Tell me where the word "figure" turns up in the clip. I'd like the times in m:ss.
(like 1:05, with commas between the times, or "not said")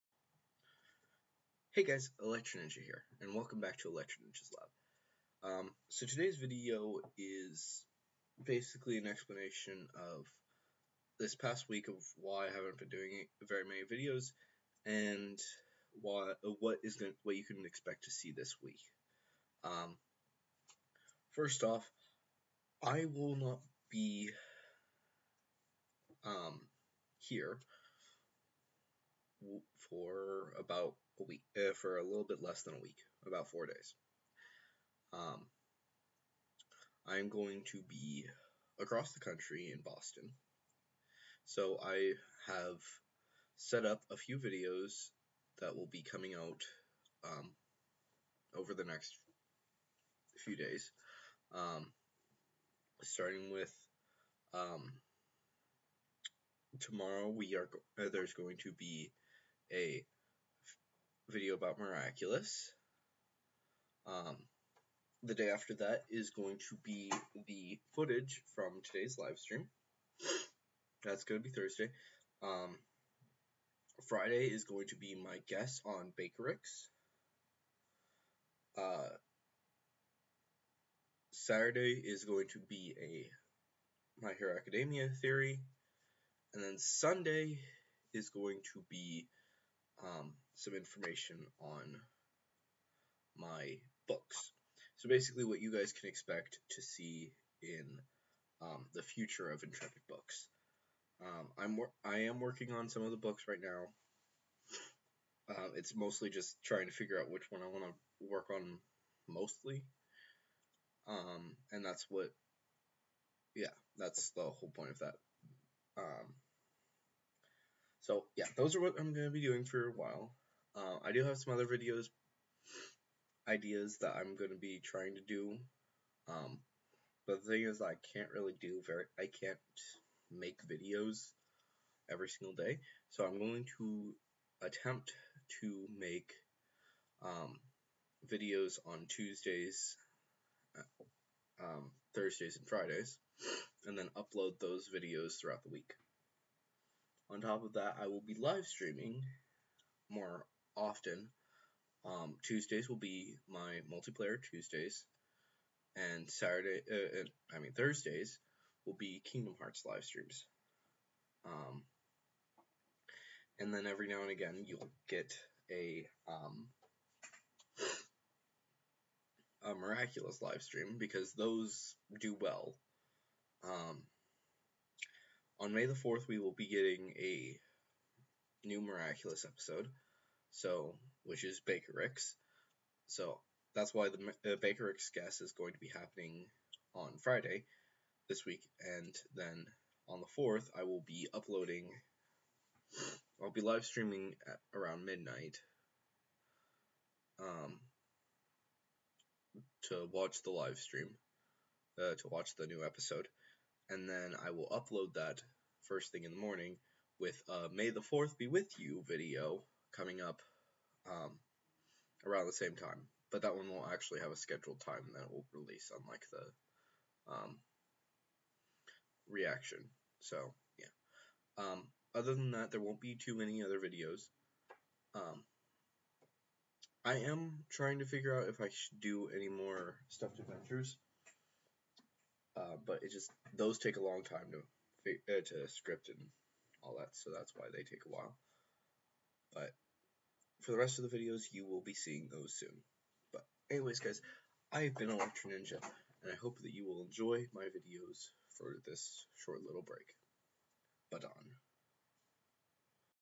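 1:46, 3:48.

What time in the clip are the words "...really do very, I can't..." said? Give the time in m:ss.
2:08.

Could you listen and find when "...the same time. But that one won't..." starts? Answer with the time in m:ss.
3:32.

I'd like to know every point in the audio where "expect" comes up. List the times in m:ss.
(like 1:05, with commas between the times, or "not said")
0:17, 1:36.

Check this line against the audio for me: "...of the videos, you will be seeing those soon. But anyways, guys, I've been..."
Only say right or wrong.
right.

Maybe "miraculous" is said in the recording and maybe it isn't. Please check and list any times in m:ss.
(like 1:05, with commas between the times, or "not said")
1:01, 2:49, 2:58.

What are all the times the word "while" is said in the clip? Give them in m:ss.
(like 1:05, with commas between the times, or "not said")
1:59, 3:58.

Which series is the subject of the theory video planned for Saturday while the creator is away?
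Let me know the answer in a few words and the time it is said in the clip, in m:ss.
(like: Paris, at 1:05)
My Hero Academia, at 1:24.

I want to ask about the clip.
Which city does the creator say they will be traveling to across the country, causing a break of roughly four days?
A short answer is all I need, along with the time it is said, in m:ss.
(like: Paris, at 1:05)
Boston, at 0:39.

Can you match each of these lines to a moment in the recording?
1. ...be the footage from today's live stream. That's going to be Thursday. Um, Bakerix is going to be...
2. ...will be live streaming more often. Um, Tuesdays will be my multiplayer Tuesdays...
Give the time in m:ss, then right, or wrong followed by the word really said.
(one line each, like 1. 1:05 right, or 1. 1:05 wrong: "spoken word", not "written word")
1. 1:06 wrong: "Friday", not "Bakerix"
2. 2:28 right.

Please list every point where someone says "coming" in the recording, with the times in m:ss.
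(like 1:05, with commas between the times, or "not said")
0:46, 3:29.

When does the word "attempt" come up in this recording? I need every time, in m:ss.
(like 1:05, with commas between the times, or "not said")
2:14.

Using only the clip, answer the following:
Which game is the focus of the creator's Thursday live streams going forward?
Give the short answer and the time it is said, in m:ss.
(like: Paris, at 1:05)
Kingdom Hearts, at 2:39.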